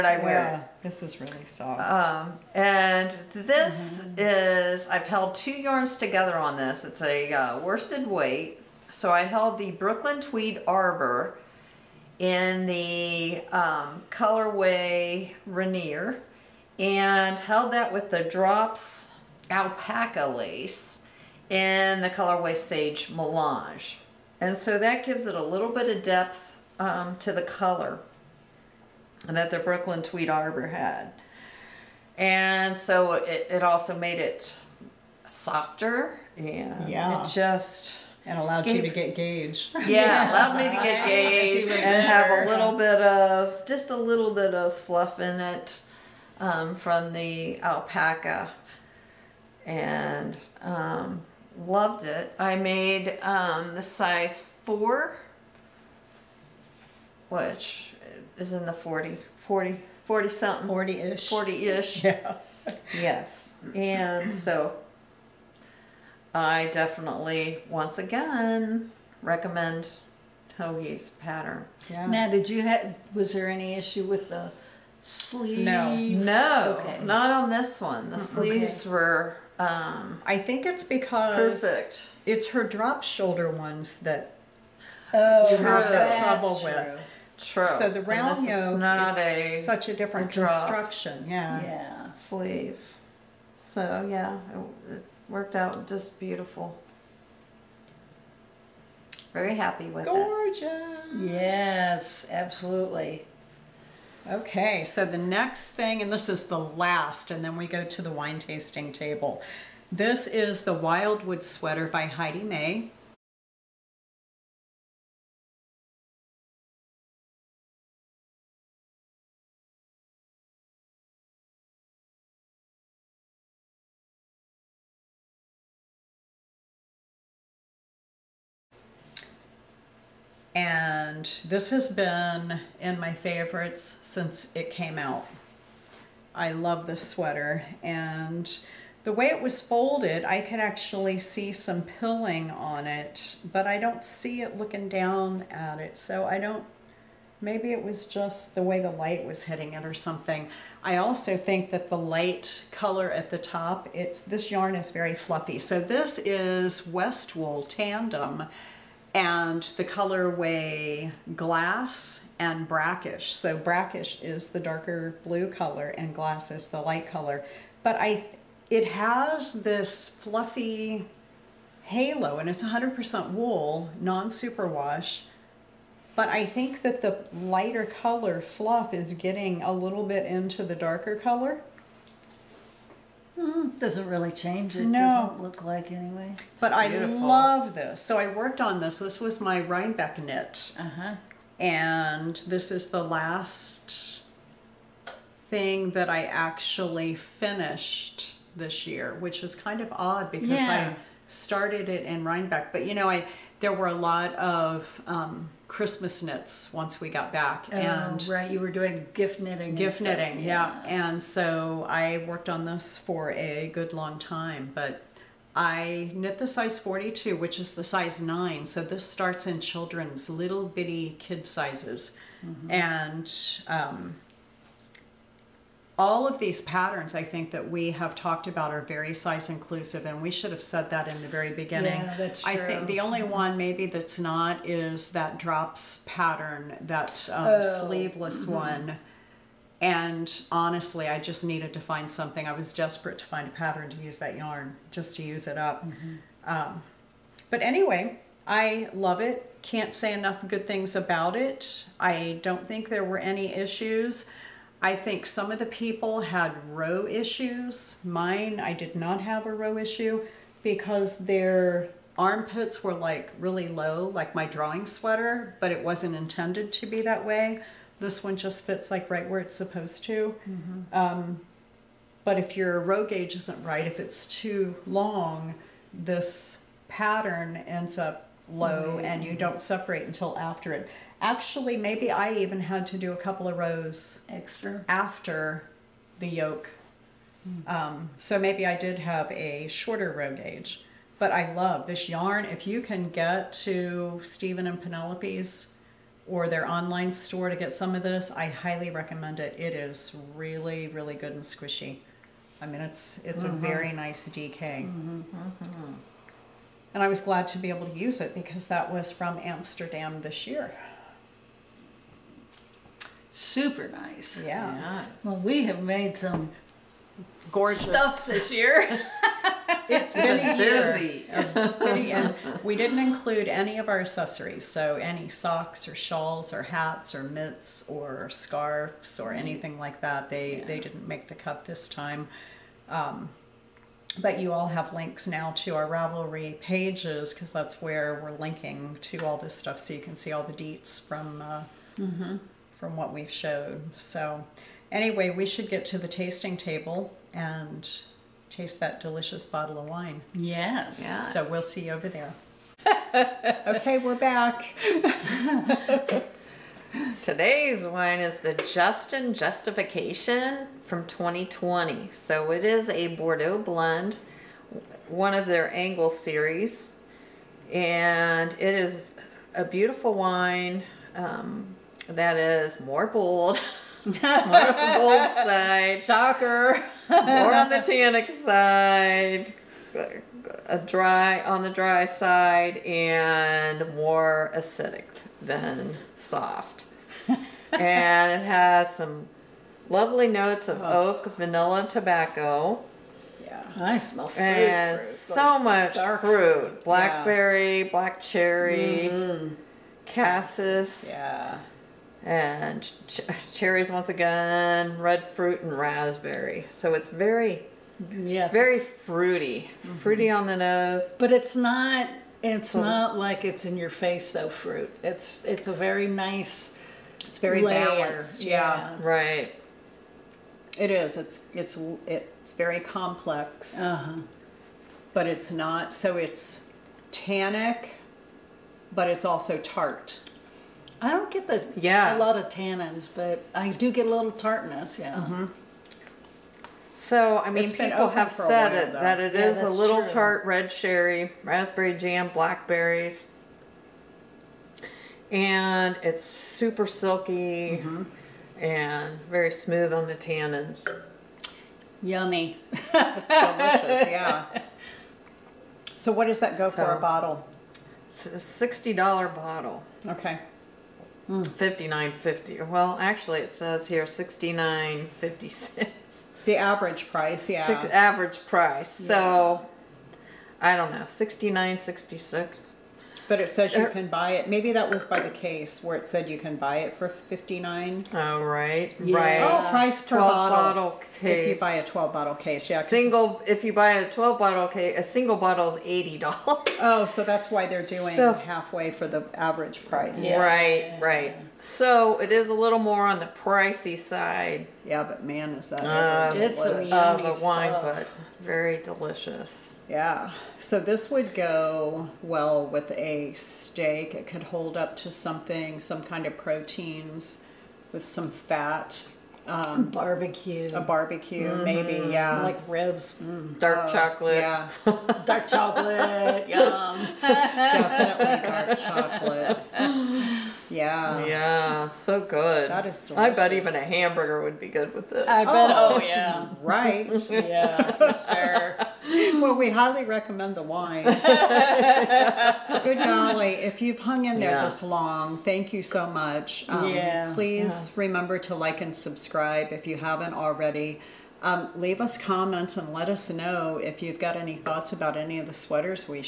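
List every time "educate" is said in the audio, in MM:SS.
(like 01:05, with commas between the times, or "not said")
not said.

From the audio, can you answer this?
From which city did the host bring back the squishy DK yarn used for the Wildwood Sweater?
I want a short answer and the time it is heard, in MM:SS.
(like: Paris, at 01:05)
Amsterdam, at 05:09.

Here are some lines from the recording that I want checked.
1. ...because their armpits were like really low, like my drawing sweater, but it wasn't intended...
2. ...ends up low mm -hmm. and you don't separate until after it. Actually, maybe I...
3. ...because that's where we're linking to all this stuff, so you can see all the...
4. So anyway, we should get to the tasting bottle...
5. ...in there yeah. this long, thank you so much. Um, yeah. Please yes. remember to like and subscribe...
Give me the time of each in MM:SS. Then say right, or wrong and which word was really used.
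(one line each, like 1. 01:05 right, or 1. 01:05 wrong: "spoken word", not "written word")
1. 04:20 right
2. 04:37 right
3. 05:37 right
4. 05:43 wrong: "table", not "bottle"
5. 08:54 right.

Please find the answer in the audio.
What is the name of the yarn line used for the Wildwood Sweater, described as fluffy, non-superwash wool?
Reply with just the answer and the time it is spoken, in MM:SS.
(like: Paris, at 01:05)
West Wool Tandem, at 02:36.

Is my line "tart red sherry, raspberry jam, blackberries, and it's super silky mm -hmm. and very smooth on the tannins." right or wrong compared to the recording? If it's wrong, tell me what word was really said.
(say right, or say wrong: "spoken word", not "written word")
right.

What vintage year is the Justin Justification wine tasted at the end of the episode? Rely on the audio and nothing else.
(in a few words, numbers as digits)
2020.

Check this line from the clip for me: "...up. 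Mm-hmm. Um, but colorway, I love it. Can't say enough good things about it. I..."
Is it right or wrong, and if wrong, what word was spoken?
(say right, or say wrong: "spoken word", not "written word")
wrong: "anyway", not "colorway".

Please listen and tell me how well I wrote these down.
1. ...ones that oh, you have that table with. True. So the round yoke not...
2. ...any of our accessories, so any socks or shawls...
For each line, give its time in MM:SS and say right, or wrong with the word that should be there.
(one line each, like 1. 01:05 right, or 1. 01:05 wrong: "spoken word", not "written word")
1. 01:23 wrong: "trouble", not "table"
2. 05:23 right.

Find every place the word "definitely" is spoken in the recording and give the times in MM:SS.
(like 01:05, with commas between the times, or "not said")
01:06, 08:37.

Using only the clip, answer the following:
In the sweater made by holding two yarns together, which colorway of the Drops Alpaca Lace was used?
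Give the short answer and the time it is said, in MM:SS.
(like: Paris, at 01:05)
Sage Melange, at 00:22.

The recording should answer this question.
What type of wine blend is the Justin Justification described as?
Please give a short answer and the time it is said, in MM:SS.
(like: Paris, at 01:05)
Bordeaux blend, at 06:03.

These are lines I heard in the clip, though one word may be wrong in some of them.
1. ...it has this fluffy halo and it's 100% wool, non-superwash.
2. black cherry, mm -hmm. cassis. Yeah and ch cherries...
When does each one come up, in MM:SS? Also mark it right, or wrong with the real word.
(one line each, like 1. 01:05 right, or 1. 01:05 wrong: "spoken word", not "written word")
1. 02:48 right
2. 06:37 right.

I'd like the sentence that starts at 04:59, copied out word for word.
It is really, really good and squishy.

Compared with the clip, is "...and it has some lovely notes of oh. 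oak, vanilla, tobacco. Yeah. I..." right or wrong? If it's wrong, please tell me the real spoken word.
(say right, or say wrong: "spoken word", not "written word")
right.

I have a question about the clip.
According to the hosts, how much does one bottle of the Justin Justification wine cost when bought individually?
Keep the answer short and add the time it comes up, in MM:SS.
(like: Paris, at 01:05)
$80, at 08:05.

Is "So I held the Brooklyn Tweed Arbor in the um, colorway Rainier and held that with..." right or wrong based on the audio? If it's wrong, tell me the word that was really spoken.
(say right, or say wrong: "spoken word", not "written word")
right.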